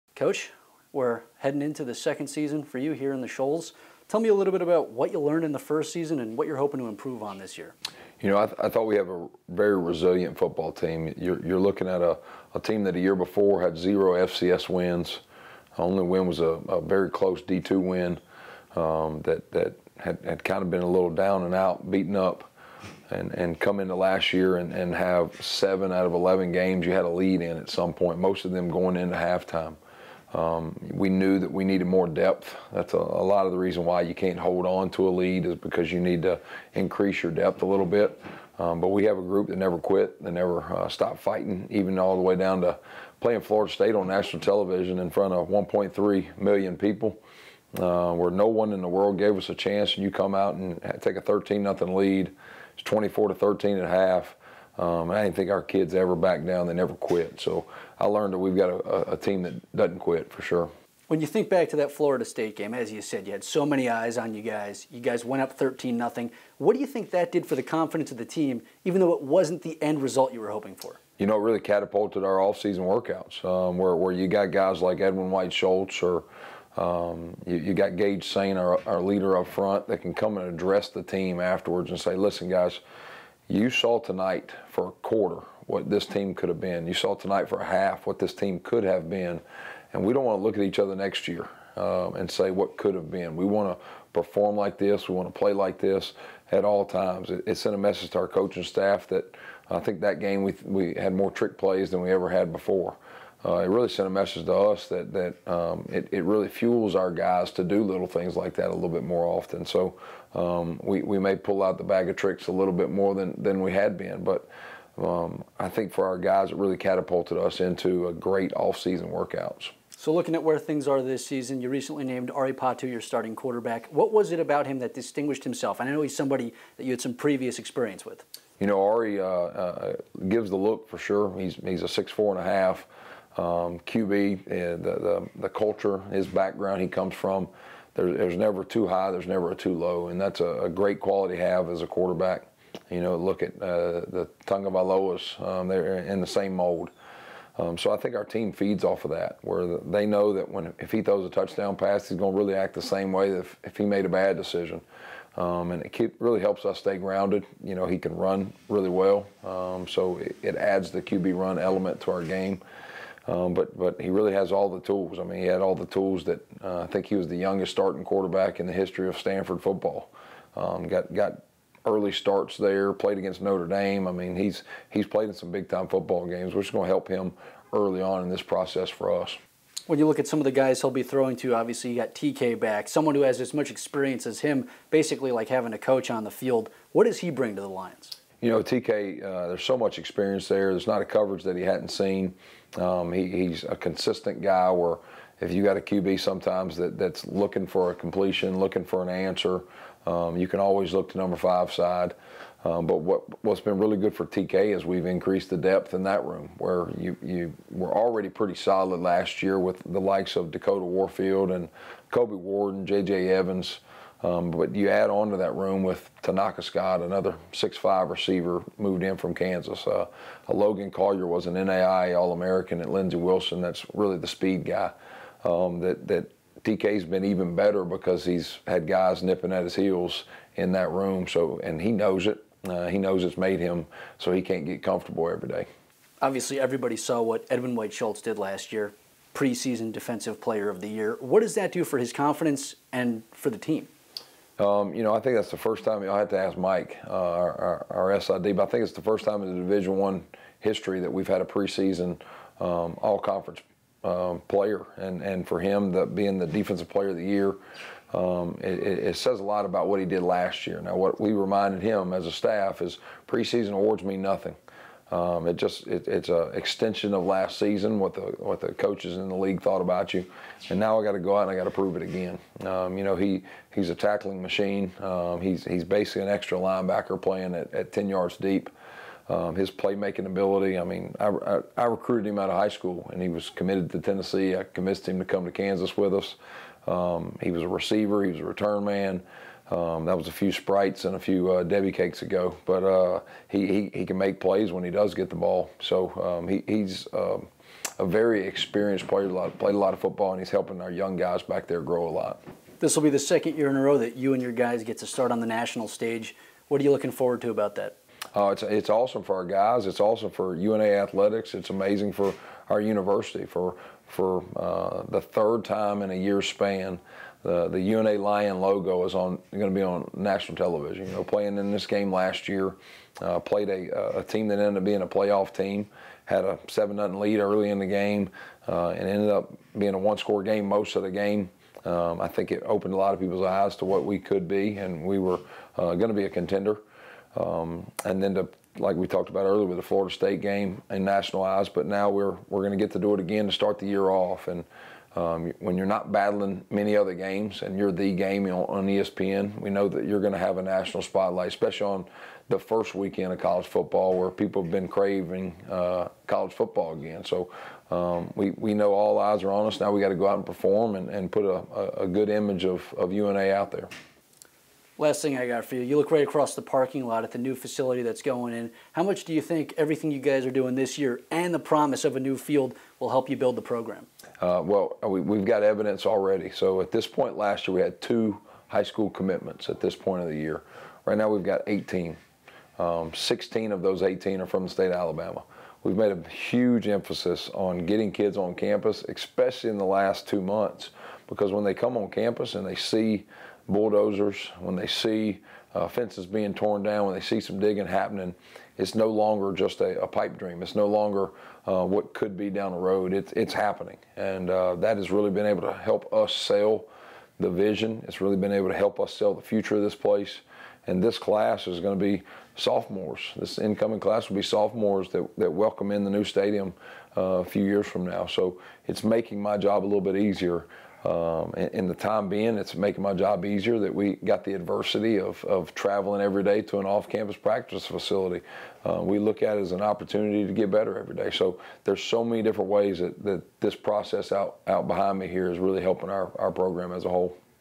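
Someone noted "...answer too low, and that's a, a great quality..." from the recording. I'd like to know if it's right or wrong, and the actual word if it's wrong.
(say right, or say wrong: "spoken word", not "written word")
wrong: "never", not "answer".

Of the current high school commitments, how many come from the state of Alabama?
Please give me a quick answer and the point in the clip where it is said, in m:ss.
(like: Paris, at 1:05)
16, at 6:23.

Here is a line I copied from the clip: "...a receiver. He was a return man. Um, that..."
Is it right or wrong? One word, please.
right.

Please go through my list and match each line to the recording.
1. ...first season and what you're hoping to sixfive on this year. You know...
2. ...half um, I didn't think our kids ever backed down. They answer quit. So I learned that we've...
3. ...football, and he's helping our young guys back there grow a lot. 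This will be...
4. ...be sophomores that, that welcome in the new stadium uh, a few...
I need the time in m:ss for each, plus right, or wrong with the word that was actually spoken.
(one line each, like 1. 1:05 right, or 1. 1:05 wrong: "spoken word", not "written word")
1. 0:05 wrong: "improve", not "sixfive"
2. 0:53 wrong: "never", not "answer"
3. 5:00 right
4. 6:54 right.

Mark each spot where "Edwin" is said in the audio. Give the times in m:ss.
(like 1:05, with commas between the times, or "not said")
1:15, 3:57.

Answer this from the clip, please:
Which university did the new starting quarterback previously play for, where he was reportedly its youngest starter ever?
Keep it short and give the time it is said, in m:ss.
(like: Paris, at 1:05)
Stanford, at 2:49.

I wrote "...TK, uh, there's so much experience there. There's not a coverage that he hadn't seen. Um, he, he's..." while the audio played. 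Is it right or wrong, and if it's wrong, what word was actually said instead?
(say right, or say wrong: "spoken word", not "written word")
right.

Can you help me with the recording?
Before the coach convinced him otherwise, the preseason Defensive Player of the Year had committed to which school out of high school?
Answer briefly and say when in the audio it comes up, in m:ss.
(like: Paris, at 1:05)
Tennessee, at 4:43.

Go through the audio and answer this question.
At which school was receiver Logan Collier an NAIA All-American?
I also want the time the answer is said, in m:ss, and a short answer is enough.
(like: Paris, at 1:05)
Lindsey Wilson, at 3:42.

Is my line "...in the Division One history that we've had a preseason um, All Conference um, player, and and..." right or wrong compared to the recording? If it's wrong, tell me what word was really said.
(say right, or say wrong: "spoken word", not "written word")
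right.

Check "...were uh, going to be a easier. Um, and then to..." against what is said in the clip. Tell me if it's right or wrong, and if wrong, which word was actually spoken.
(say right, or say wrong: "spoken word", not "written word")
wrong: "contender", not "easier".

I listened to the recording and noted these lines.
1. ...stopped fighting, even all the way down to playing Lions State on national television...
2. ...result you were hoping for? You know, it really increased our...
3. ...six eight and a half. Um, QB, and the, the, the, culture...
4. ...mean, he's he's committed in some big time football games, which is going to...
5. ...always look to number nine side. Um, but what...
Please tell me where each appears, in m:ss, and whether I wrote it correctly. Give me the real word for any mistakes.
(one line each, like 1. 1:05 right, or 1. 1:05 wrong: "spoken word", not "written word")
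1. 0:40 wrong: "Florida", not "Lions"
2. 1:10 wrong: "catapulted", not "increased"
3. 2:11 wrong: "four", not "eight"
4. 2:54 wrong: "played", not "committed"
5. 3:20 wrong: "five", not "nine".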